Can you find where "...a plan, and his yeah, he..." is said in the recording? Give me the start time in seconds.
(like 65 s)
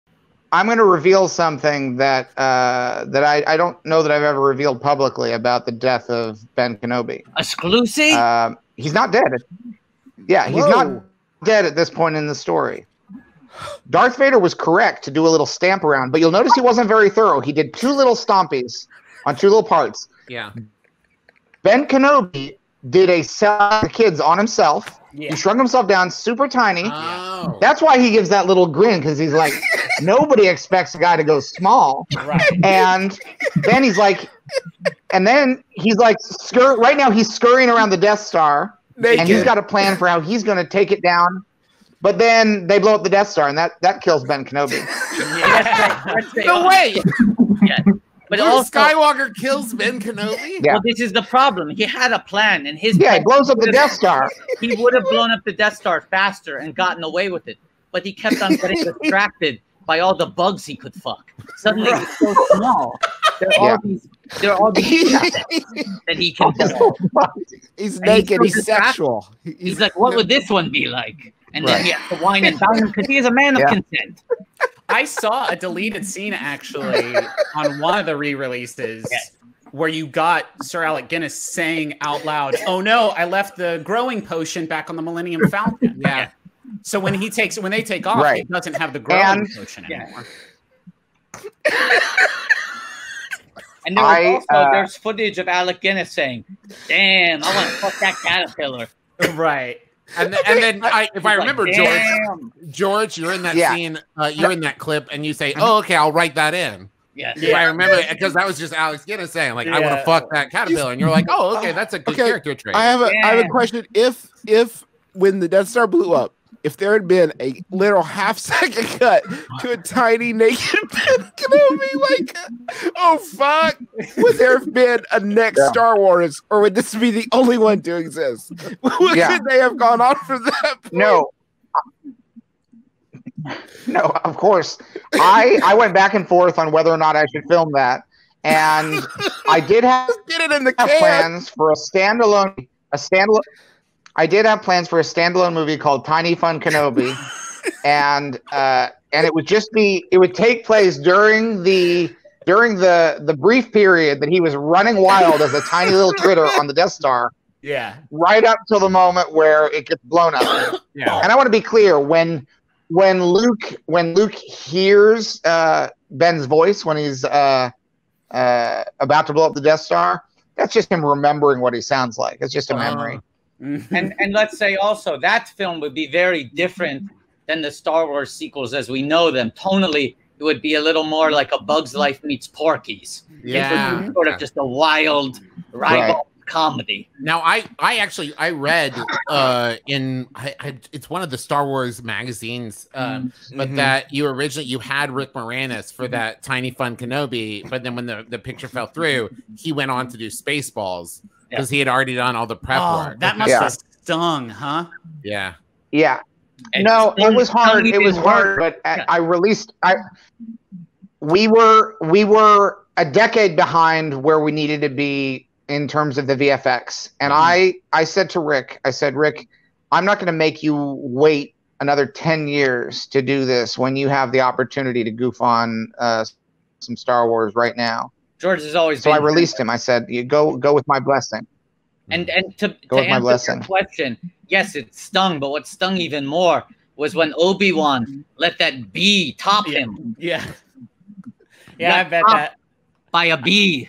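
52 s.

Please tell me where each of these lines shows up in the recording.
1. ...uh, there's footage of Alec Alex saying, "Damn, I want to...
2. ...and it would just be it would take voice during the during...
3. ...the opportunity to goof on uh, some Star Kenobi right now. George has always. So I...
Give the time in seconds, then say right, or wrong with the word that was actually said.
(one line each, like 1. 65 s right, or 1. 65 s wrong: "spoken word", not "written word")
1. 94 s wrong: "Guinness", not "Alex"
2. 149 s wrong: "place", not "voice"
3. 224 s wrong: "Wars", not "Kenobi".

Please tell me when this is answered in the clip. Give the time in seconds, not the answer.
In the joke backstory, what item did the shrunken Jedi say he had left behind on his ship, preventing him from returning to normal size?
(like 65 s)
83 s.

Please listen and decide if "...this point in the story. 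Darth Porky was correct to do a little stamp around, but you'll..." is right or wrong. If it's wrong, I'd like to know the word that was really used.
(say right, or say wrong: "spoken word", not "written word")
wrong: "Vader", not "Porky".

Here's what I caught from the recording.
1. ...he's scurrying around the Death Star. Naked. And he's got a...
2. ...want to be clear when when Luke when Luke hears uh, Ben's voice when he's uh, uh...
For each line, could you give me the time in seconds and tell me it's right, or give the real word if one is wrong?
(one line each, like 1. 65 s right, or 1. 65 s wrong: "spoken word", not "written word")
1. 37 s right
2. 161 s right.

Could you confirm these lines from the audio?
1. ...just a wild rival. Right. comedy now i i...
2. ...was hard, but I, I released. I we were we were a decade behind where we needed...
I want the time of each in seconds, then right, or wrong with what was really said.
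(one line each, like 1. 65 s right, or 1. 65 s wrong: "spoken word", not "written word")
1. 184 s right
2. 208 s right.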